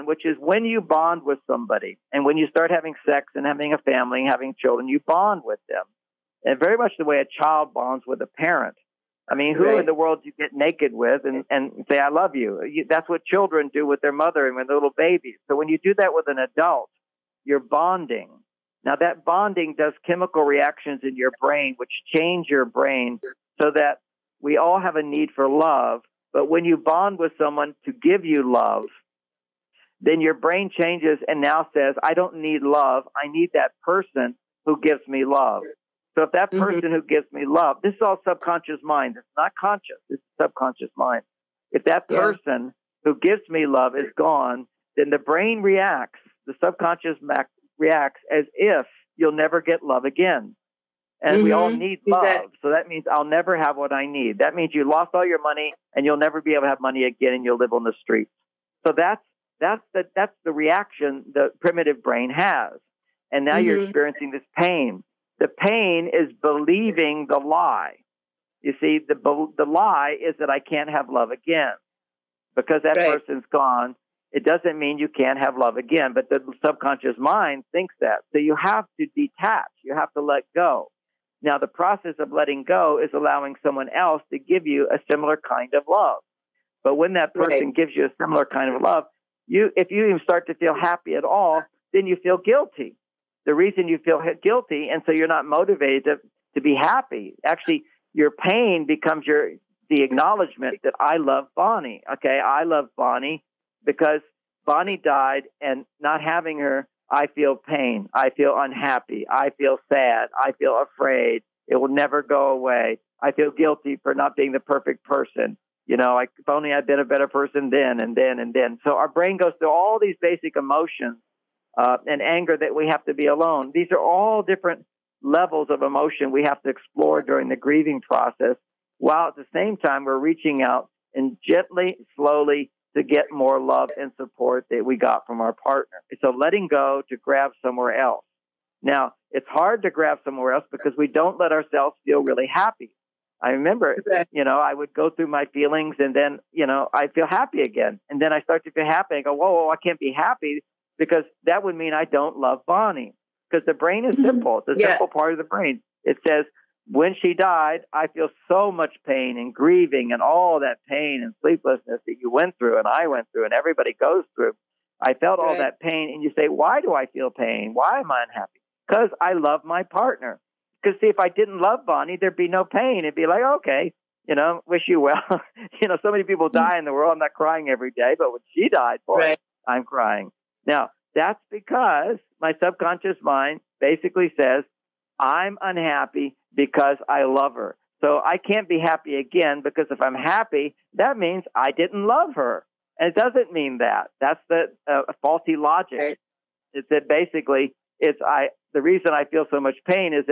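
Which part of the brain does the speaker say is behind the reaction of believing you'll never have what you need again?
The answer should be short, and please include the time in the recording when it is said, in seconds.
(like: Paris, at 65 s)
primitive brain, at 61 s.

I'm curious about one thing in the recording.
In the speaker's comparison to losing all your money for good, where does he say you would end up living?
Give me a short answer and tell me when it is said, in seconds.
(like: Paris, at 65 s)
on the streets, at 57 s.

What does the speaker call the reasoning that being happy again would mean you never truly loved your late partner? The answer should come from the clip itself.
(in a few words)
faulty logic.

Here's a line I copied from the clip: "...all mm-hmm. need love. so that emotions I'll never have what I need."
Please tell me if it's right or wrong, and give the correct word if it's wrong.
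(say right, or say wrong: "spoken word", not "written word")
wrong: "means", not "emotions".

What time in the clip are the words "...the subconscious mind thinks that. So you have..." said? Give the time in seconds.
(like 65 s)
76 s.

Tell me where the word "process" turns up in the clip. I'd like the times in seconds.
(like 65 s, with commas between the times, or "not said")
81 s, 128 s.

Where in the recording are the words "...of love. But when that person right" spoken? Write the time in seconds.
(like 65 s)
85 s.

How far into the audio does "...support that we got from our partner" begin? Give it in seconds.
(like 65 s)
134 s.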